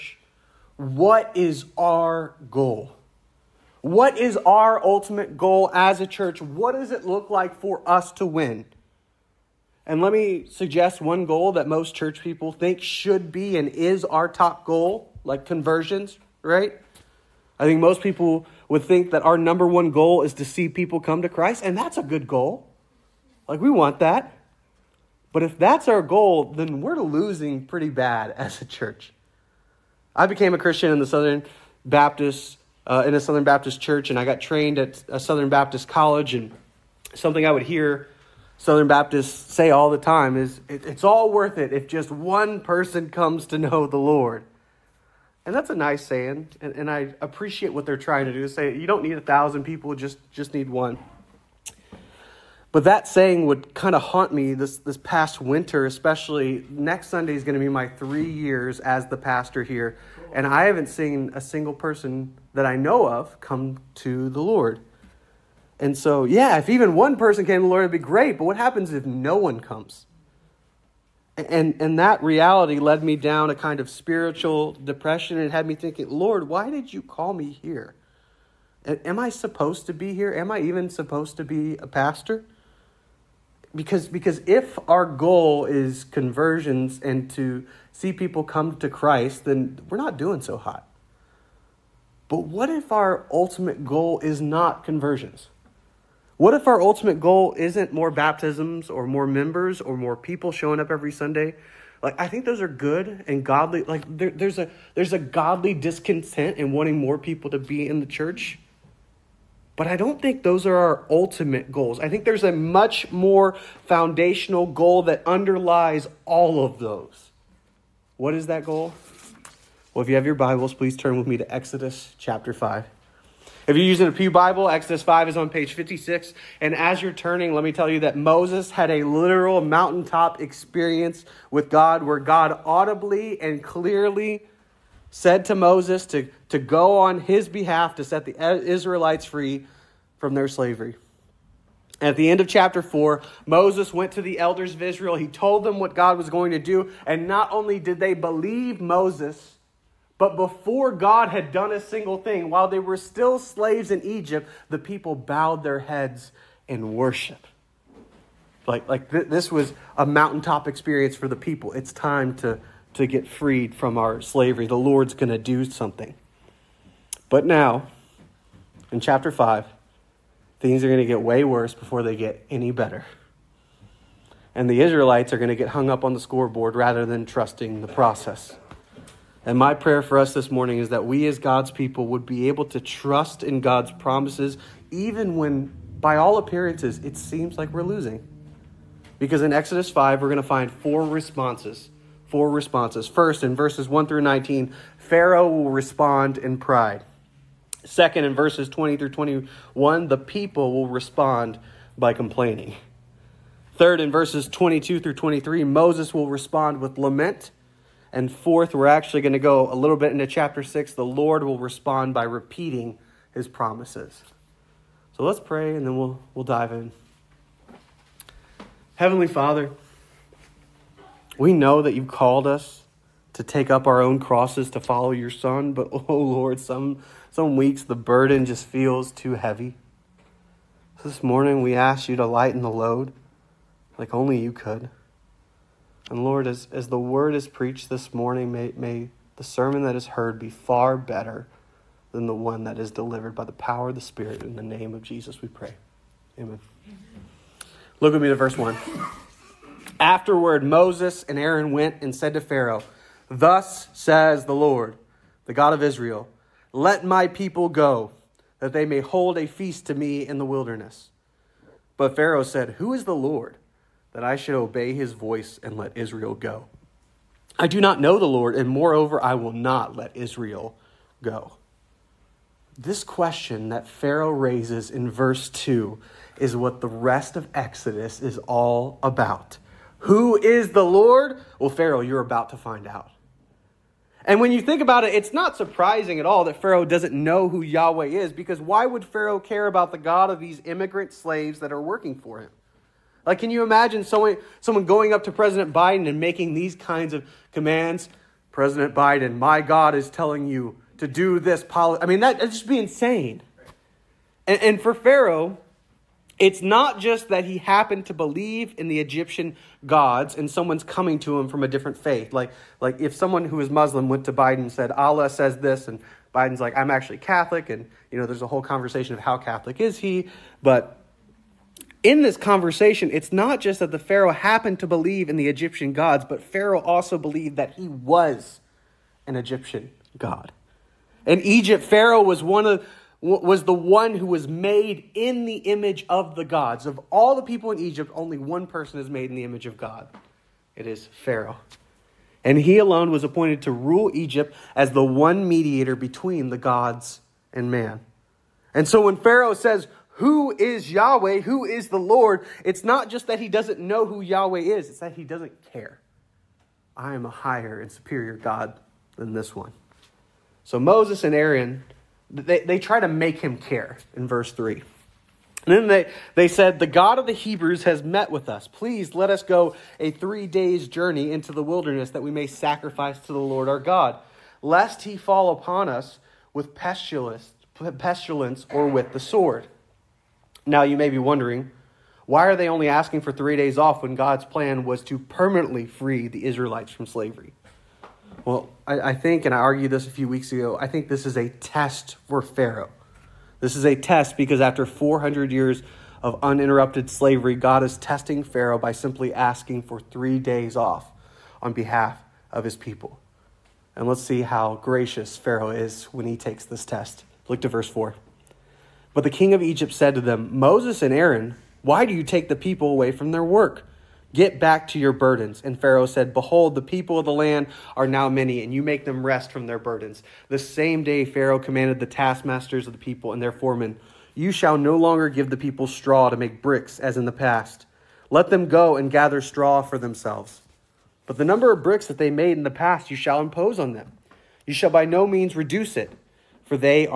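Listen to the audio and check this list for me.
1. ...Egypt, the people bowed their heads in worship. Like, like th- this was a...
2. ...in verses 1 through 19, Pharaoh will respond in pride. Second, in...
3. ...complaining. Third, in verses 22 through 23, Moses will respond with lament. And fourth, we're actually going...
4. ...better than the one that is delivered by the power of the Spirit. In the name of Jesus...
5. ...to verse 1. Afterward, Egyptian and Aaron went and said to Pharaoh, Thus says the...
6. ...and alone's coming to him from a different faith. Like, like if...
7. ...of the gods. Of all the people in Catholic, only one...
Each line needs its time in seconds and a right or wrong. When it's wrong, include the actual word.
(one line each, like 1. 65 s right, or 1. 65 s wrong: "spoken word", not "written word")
1. 154 s right
2. 193 s right
3. 202 s right
4. 240 s right
5. 248 s wrong: "Moses", not "Egyptian"
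6. 310 s wrong: "someone", not "alone"
7. 336 s wrong: "Egypt", not "Catholic".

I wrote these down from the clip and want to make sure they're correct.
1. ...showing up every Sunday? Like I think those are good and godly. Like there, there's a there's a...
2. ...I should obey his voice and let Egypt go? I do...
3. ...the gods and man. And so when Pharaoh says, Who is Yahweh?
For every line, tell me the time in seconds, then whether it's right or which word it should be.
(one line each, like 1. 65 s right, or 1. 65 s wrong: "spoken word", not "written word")
1. 100 s right
2. 264 s wrong: "Israel", not "Egypt"
3. 346 s right.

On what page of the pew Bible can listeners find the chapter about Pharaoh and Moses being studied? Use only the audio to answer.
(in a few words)
56.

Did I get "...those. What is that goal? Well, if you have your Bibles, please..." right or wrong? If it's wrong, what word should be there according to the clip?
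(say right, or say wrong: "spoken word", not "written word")
right.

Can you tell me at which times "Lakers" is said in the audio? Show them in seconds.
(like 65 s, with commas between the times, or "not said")
not said.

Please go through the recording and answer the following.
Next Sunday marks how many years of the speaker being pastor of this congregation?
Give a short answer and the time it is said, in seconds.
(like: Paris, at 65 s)
3, at 57 s.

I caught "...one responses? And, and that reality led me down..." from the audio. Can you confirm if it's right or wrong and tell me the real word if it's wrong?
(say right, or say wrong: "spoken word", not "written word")
wrong: "comes", not "responses".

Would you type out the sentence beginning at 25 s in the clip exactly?
But if that's our goal, then we're losing pretty bad as a church.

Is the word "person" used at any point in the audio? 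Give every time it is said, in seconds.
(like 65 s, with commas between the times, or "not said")
42 s, 61 s, 67 s, 338 s.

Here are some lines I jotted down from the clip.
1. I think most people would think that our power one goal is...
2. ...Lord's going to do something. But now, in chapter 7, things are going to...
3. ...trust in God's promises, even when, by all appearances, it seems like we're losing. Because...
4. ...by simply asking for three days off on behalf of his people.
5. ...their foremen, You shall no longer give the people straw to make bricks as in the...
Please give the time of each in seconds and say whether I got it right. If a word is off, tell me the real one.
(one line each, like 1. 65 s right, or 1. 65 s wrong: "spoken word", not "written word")
1. 17 s wrong: "number", not "power"
2. 164 s wrong: "5", not "7"
3. 182 s right
4. 398 s right
5. 423 s right.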